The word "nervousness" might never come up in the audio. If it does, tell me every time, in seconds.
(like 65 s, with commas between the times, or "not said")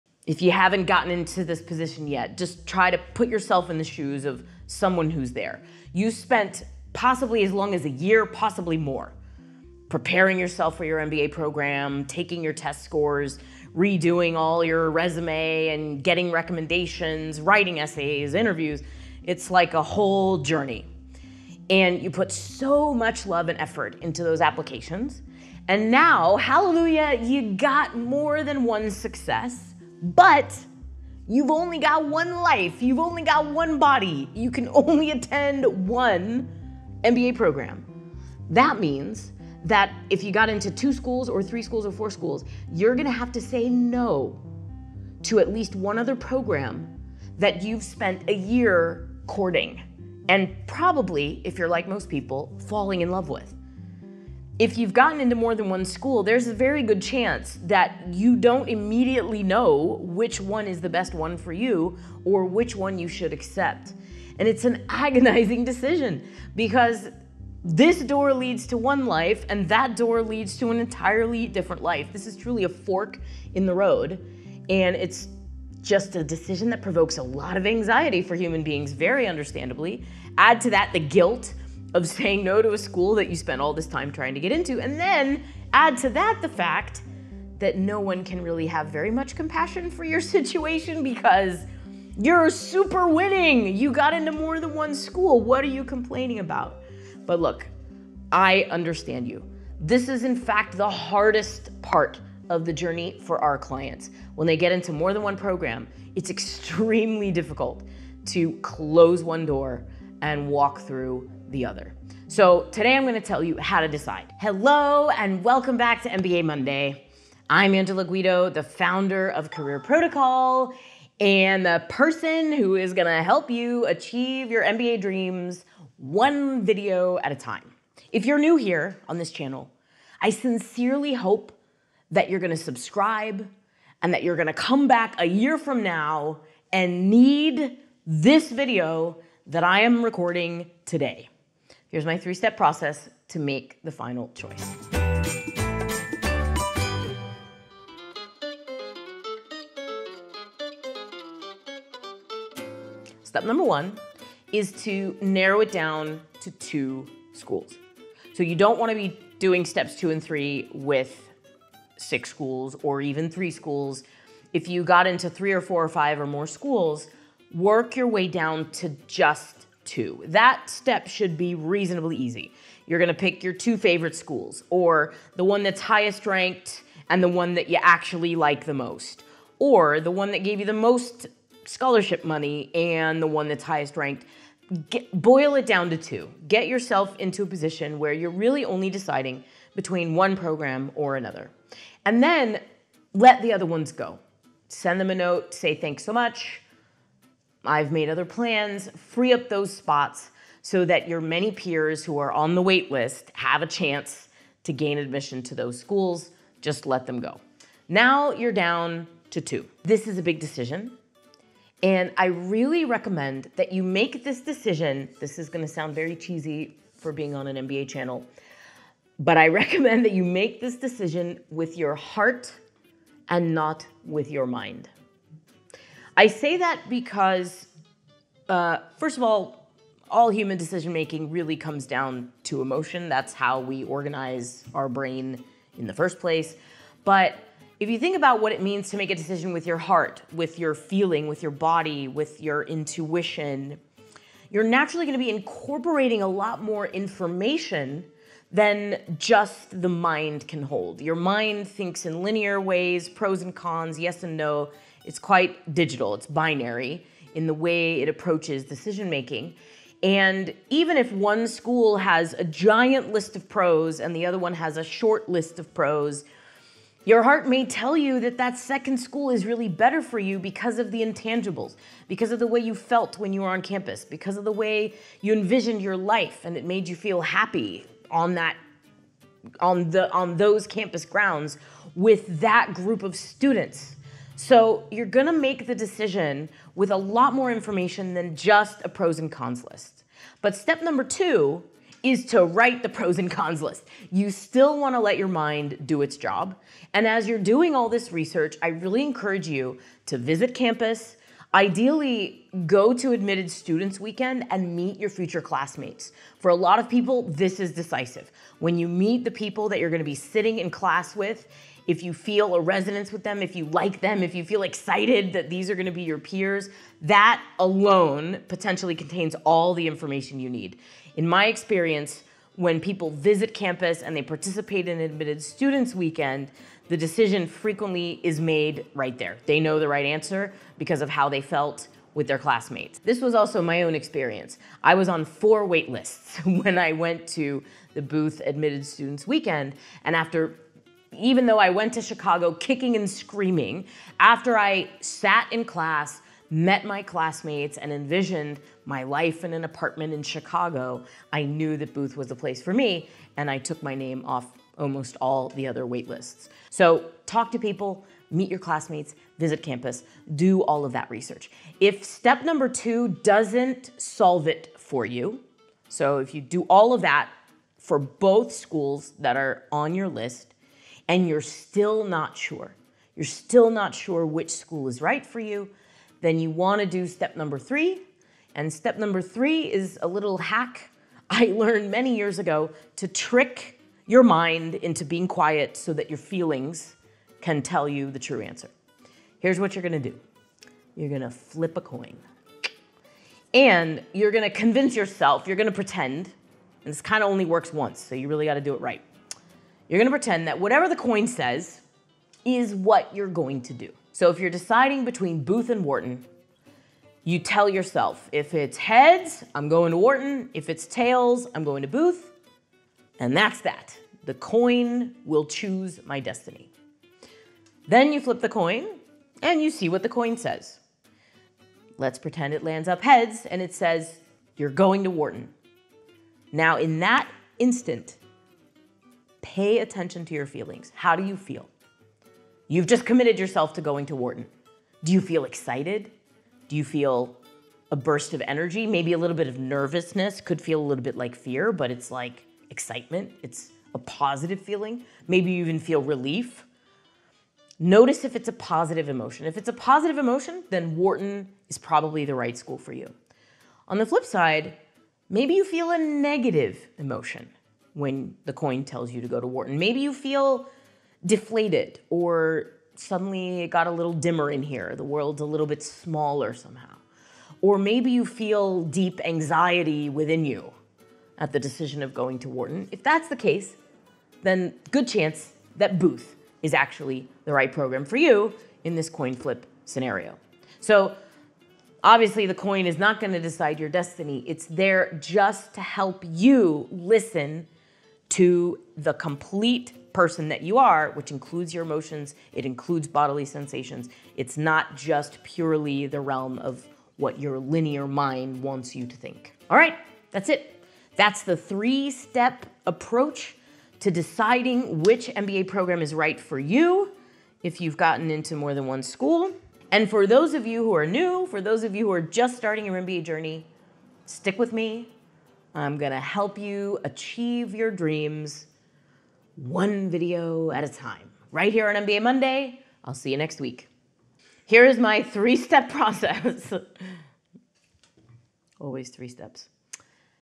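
439 s.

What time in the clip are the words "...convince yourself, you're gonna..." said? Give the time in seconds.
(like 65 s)
394 s.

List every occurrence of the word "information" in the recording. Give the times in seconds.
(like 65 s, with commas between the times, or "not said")
246 s, 287 s, 319 s.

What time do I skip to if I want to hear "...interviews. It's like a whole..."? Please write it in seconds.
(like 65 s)
18 s.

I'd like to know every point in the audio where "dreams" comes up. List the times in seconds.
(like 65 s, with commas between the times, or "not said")
125 s, 517 s.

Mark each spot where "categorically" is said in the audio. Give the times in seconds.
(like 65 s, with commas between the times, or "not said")
not said.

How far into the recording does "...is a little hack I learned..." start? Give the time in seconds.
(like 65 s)
379 s.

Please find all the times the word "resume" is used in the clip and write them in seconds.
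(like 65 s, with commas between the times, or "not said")
14 s.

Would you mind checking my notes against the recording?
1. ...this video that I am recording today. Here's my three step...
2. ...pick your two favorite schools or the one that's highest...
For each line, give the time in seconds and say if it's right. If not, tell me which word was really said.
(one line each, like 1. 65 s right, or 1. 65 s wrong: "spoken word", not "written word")
1. 138 s right
2. 173 s right.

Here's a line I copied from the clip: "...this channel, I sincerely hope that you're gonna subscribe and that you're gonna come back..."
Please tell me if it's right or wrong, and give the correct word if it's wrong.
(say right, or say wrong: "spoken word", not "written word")
right.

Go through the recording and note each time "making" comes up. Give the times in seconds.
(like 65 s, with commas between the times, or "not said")
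230 s, 259 s.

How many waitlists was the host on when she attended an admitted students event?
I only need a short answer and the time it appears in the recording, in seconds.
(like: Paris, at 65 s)
4, at 335 s.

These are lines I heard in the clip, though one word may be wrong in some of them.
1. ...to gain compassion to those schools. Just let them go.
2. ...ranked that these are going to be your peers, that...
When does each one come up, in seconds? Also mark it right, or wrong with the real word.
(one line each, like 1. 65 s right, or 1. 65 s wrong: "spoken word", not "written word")
1. 204 s wrong: "admission", not "compassion"
2. 314 s wrong: "excited", not "ranked".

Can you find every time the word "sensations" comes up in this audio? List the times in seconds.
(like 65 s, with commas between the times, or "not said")
493 s.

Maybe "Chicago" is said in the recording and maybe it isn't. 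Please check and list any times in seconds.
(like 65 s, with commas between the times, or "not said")
342 s, 350 s.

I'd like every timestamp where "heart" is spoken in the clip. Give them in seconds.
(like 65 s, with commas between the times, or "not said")
221 s, 239 s, 267 s.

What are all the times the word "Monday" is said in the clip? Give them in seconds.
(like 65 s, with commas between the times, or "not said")
116 s, 522 s.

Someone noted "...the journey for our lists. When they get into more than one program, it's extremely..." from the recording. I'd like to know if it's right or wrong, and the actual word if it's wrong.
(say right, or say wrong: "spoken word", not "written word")
wrong: "clients", not "lists".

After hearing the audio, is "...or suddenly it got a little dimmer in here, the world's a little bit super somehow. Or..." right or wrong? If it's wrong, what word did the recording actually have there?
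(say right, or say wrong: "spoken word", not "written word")
wrong: "smaller", not "super".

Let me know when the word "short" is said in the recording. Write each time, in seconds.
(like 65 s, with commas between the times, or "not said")
264 s.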